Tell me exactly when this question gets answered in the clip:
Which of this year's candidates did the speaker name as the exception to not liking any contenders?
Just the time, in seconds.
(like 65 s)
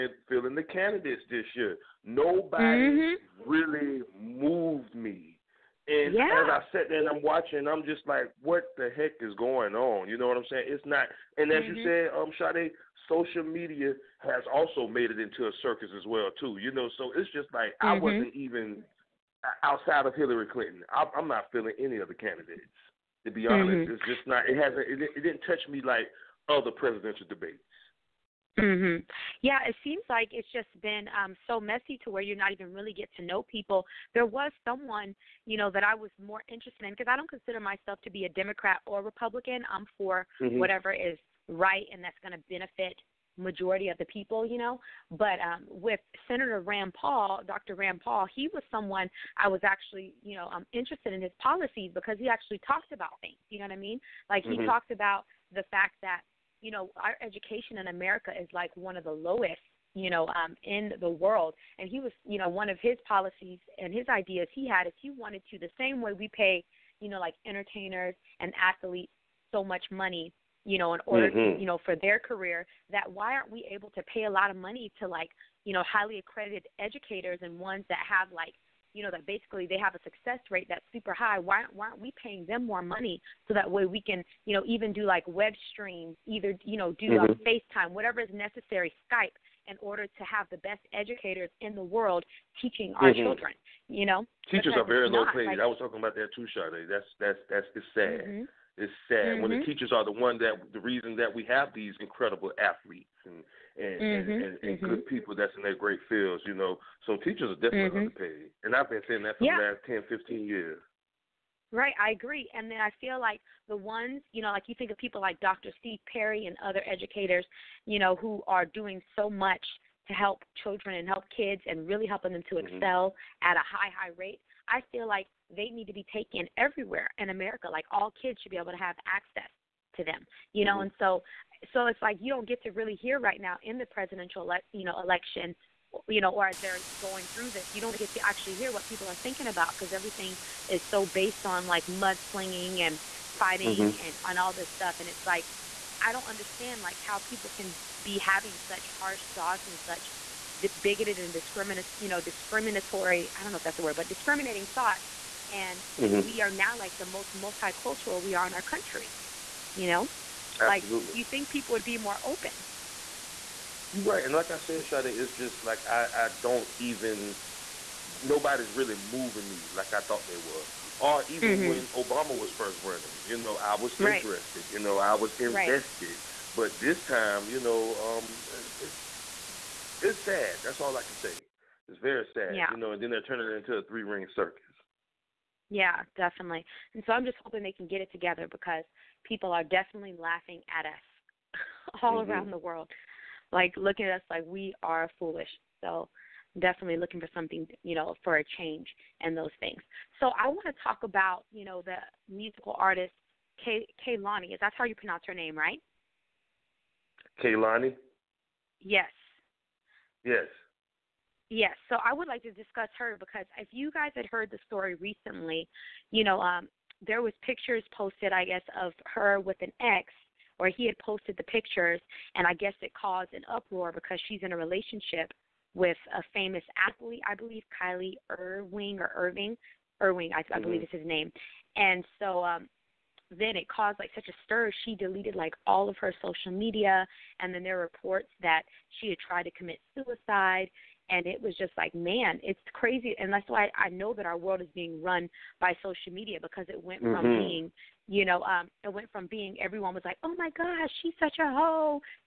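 20 s.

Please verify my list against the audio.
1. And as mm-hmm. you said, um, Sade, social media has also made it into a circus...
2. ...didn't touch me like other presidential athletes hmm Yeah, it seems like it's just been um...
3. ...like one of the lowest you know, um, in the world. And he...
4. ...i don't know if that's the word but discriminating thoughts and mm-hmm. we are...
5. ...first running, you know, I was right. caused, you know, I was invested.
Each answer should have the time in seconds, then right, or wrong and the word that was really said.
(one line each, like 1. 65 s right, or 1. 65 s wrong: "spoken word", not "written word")
1. 11 s right
2. 25 s wrong: "debates", not "athletes"
3. 58 s right
4. 153 s right
5. 172 s wrong: "interested", not "caused".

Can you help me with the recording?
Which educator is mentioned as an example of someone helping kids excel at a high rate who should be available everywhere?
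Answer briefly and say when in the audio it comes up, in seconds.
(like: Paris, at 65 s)
Dr. Steve Perry, at 115 s.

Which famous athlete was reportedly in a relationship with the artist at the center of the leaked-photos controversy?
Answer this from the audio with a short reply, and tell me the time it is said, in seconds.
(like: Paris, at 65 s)
Kyrie Irving, at 227 s.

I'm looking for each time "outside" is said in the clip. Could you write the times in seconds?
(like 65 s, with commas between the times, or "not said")
19 s.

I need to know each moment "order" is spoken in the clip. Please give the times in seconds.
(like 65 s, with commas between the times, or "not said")
71 s, 89 s.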